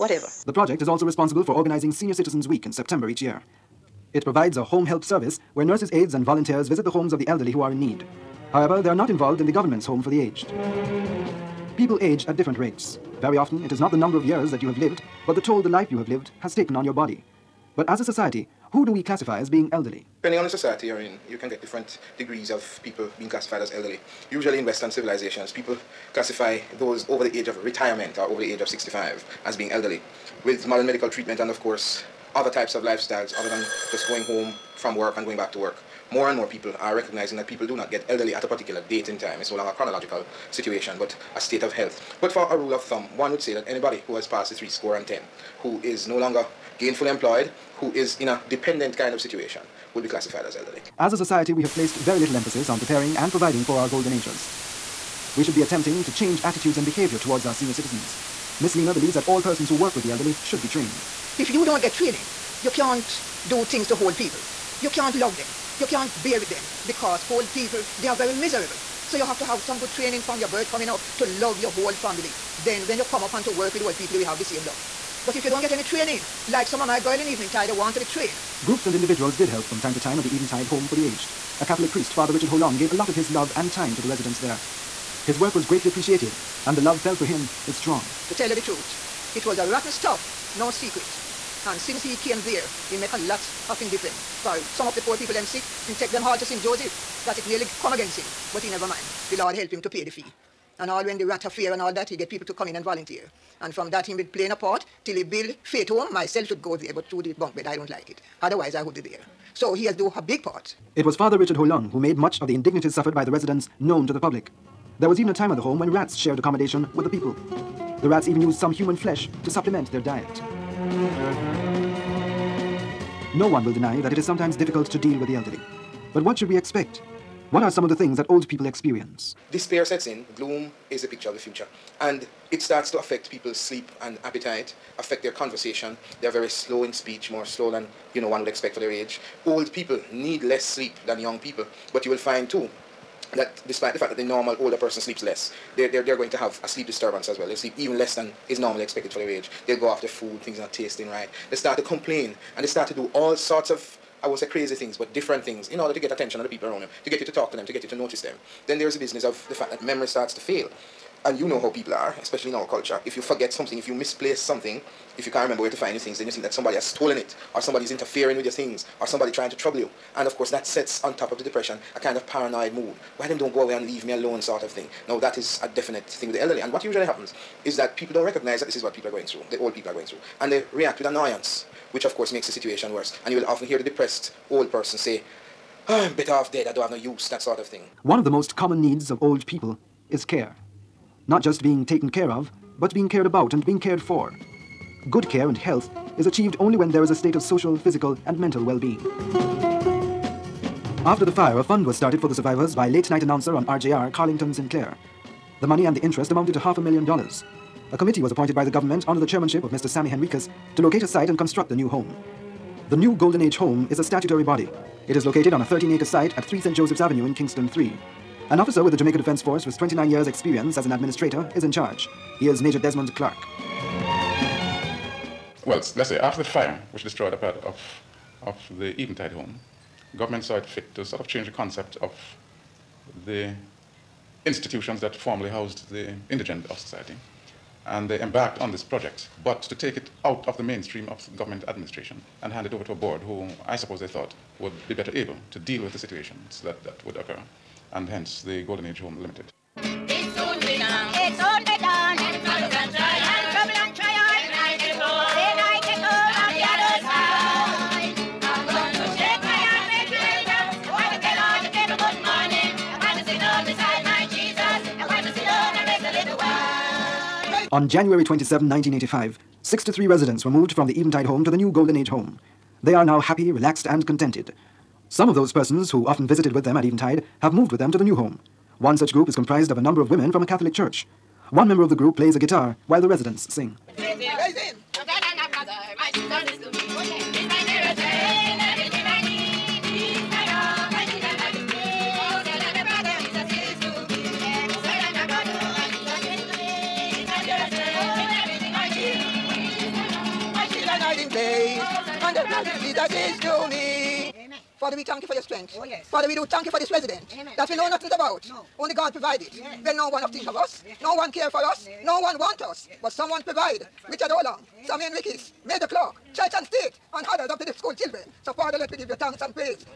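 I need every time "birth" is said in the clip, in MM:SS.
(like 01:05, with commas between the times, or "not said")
01:10.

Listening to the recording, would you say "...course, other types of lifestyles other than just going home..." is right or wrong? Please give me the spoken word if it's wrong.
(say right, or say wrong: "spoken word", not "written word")
right.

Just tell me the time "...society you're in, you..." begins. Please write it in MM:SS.
00:20.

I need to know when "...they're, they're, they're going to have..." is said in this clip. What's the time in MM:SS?
02:25.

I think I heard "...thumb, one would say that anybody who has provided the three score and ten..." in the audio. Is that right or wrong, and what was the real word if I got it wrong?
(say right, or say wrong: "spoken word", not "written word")
wrong: "passed", not "provided".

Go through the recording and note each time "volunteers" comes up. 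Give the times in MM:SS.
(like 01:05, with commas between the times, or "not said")
00:06, 01:42.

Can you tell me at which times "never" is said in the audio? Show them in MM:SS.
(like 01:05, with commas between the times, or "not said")
01:38.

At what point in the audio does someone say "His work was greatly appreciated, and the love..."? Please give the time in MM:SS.
01:25.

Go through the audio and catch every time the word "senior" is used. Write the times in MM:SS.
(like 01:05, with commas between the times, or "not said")
00:01, 00:57.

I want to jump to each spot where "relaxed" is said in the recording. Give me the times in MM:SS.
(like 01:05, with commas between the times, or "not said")
04:33.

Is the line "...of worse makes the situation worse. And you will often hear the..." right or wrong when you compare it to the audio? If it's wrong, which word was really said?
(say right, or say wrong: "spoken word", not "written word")
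wrong: "course", not "worse".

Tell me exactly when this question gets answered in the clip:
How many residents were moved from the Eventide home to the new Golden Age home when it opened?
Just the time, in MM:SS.
04:29.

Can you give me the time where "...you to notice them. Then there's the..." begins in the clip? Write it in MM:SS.
02:37.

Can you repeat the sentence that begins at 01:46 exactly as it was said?
Myself should go there, but through the bunk bed, I don't like it.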